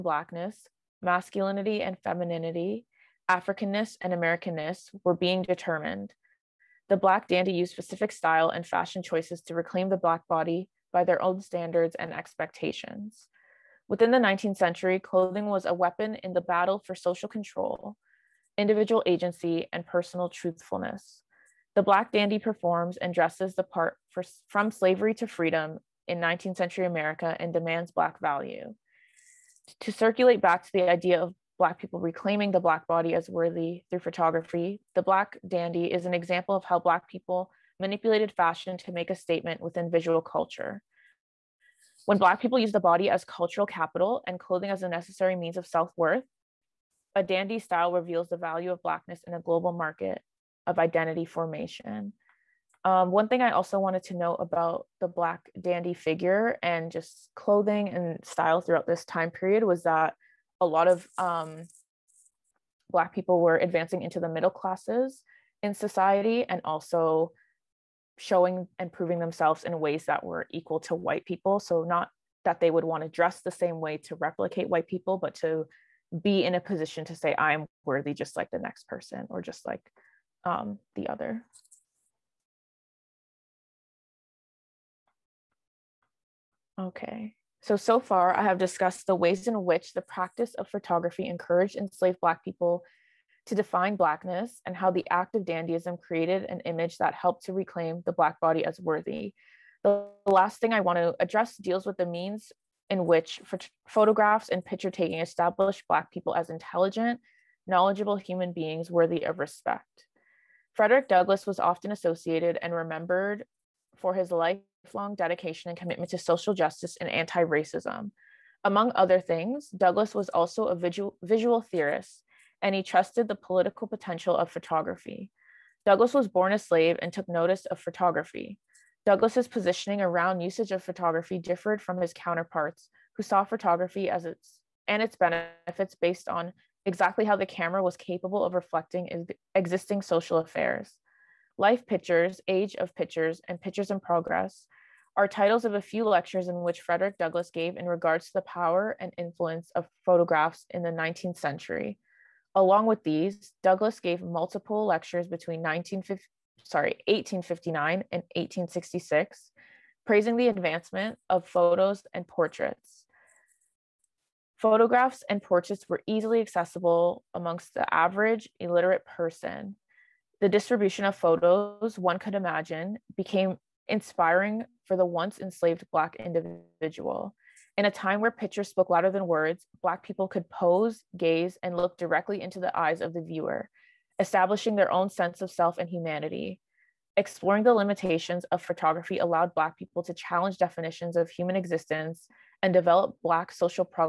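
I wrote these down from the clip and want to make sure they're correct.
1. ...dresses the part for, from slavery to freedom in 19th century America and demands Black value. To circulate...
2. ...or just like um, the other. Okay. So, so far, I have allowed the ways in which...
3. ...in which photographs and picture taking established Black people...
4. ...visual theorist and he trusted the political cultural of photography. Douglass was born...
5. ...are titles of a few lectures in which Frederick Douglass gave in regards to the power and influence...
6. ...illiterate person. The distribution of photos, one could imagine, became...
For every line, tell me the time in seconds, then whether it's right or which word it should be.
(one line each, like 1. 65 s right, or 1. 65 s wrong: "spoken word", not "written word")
1. 23 s right
2. 79 s wrong: "discussed", not "allowed"
3. 102 s right
4. 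121 s wrong: "potential", not "cultural"
5. 145 s right
6. 168 s right.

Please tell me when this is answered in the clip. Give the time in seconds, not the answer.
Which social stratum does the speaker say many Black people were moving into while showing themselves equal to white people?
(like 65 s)
64 s.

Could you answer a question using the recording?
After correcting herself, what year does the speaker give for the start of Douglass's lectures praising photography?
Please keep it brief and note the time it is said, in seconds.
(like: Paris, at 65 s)
1859, at 157 s.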